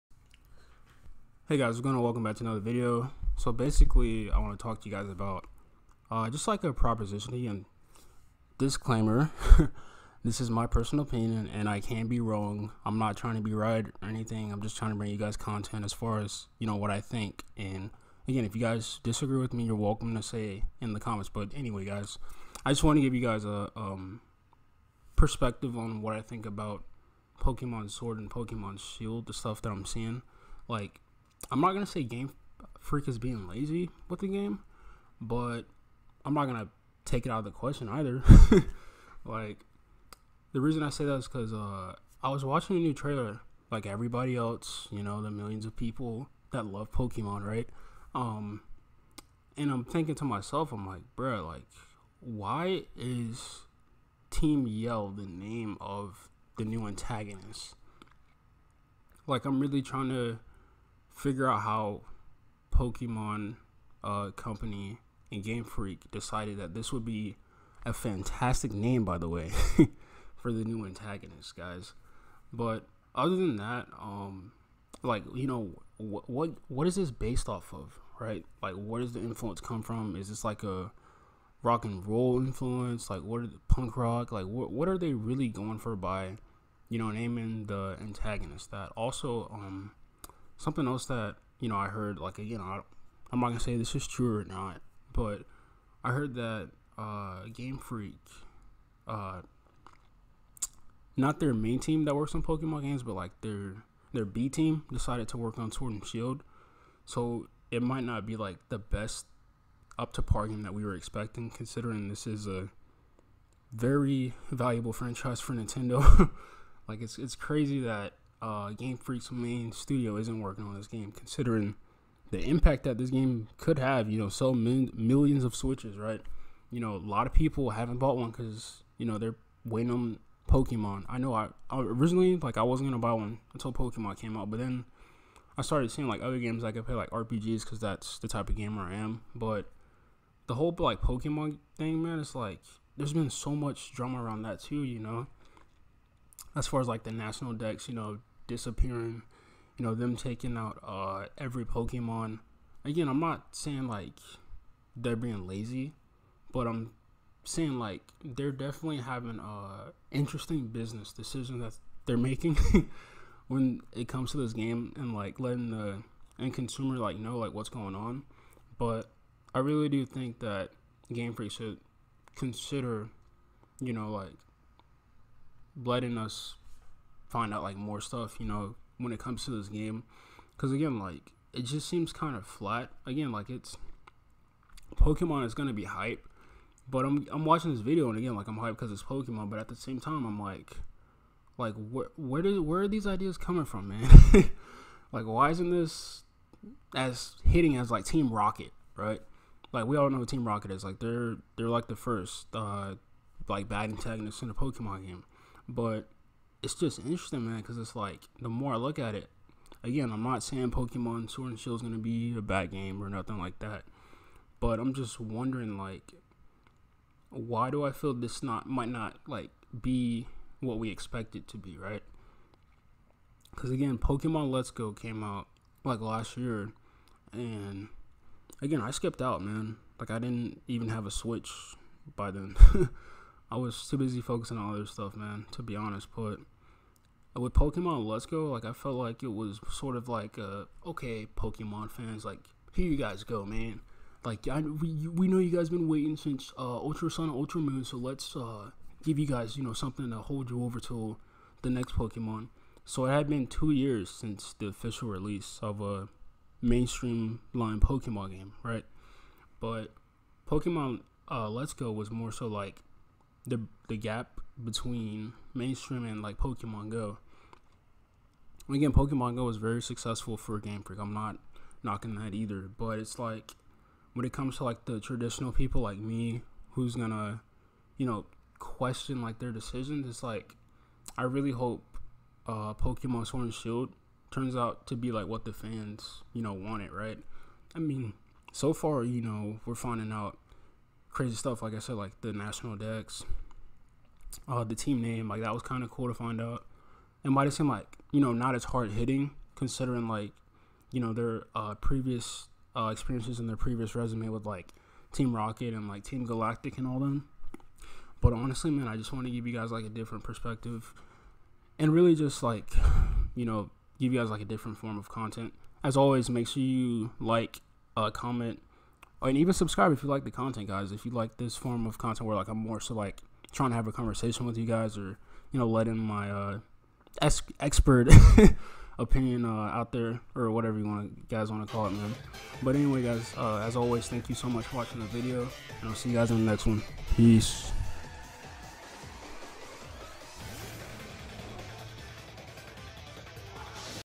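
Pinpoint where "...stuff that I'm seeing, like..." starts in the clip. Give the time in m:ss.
0:29.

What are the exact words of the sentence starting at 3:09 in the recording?
But at the same time, I'm like, like where where did where are these ideas coming from, man?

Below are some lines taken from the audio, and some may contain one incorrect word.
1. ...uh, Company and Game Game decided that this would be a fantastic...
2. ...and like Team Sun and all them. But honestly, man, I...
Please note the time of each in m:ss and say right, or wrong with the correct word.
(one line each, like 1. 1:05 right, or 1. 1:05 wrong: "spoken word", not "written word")
1. 1:04 wrong: "Freak", not "Game"
2. 5:05 wrong: "Galactic", not "Sun".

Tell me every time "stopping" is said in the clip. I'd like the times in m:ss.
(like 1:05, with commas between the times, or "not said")
not said.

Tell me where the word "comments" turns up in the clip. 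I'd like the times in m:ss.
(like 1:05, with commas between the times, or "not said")
0:21, 5:18.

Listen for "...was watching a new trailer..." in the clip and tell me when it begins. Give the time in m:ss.
0:42.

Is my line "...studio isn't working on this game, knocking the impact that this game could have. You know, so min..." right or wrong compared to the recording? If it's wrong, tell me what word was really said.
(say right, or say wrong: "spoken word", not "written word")
wrong: "considering", not "knocking".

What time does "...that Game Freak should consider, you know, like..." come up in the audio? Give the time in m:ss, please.
2:50.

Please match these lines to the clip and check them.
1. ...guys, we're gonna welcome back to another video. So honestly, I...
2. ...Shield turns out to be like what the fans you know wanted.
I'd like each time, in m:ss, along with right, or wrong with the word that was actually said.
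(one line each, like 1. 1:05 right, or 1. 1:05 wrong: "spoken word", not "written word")
1. 0:01 wrong: "basically", not "honestly"
2. 4:43 right.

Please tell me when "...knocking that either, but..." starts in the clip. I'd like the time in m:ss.
4:31.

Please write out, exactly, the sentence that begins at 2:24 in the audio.
You know, as far as like the National Dex, you know, disappearing, you know, them taking out uh, every Pokemon.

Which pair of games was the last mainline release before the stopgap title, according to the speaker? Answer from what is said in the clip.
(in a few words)
Ultra Sun, Ultra Moon.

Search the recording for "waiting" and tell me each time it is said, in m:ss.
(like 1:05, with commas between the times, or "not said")
2:09, 4:05.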